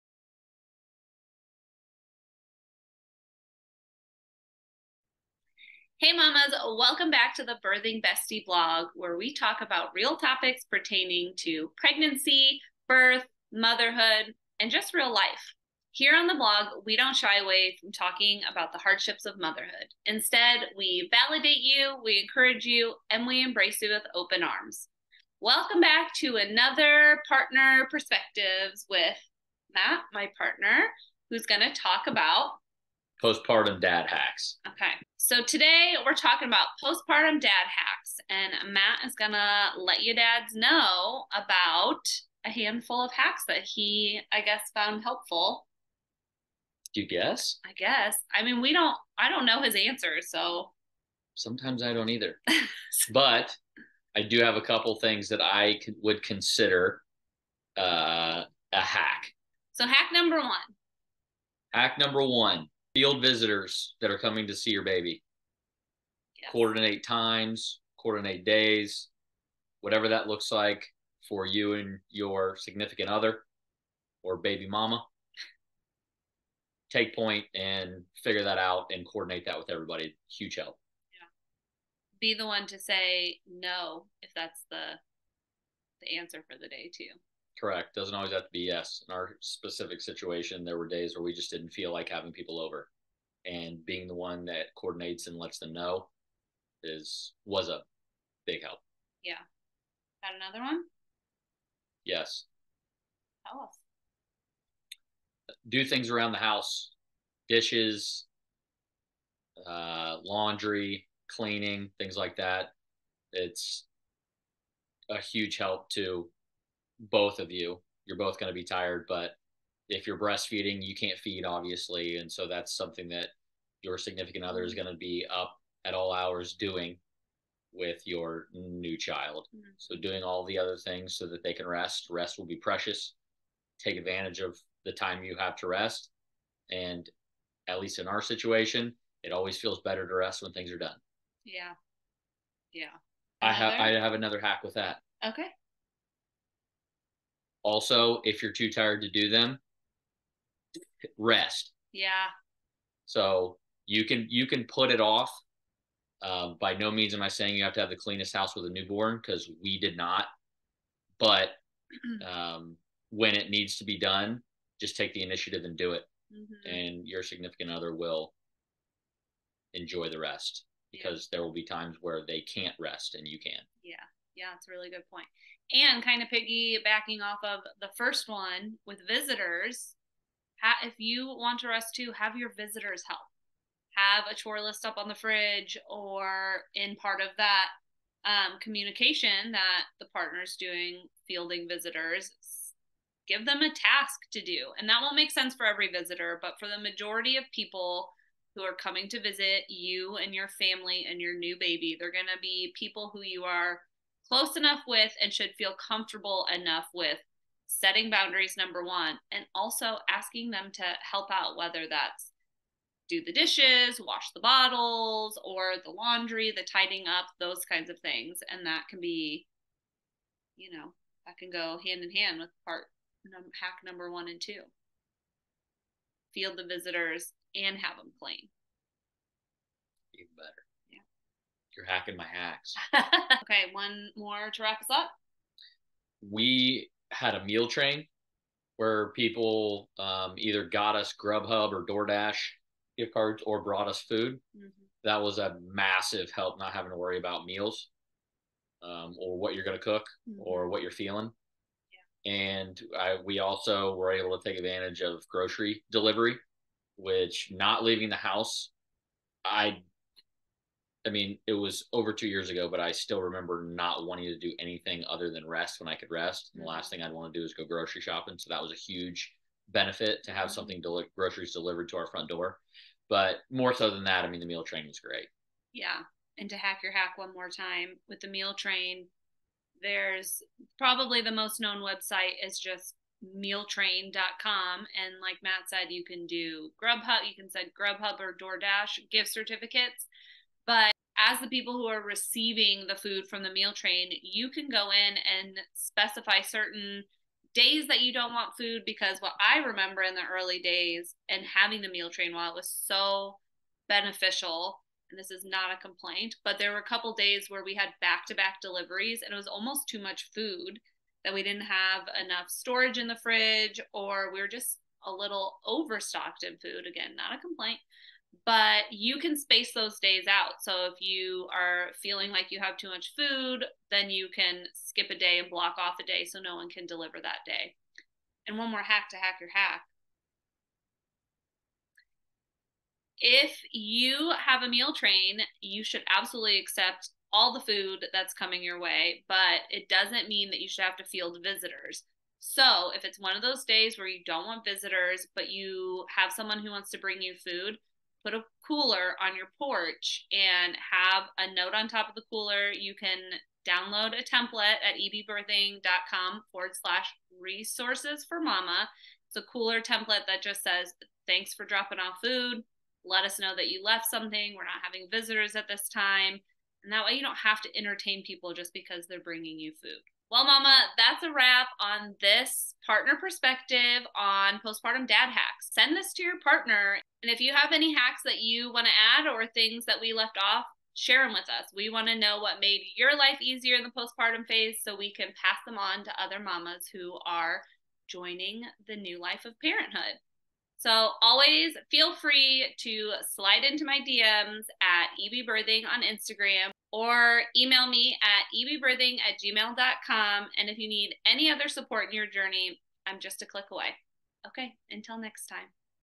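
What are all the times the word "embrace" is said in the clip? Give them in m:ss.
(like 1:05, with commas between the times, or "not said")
0:23.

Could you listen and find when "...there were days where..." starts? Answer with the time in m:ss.
1:30.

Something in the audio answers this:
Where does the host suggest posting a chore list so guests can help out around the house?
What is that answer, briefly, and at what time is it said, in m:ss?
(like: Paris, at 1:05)
On the fridge, at 3:04.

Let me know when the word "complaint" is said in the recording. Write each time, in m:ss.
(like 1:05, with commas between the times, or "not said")
5:05, 5:17.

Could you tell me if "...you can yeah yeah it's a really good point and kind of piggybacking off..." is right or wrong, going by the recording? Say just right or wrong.
right.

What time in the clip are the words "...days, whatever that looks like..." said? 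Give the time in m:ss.
1:08.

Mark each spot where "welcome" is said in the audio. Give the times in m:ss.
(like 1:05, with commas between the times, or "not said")
0:06, 0:25.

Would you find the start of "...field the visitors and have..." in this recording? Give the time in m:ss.
3:46.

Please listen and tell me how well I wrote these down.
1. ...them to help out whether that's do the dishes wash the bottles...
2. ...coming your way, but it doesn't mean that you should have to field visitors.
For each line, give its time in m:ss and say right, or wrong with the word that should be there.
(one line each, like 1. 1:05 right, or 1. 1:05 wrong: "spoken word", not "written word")
1. 3:30 right
2. 5:38 right.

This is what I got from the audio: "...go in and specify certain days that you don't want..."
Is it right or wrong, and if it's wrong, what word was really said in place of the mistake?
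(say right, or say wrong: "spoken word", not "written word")
right.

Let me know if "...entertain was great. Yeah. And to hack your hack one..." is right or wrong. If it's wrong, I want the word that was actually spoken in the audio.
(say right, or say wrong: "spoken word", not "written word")
wrong: "train", not "entertain".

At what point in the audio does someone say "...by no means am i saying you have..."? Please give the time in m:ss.
2:36.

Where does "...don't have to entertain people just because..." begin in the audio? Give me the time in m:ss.
6:07.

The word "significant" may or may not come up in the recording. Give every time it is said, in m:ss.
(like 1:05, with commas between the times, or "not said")
1:12, 2:03, 2:47.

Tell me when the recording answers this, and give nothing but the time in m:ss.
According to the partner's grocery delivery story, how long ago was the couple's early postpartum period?
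4:21.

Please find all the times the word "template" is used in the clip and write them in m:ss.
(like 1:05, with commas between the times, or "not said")
5:54, 5:59.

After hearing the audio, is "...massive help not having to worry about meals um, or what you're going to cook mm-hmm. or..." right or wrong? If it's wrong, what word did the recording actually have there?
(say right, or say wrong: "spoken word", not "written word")
right.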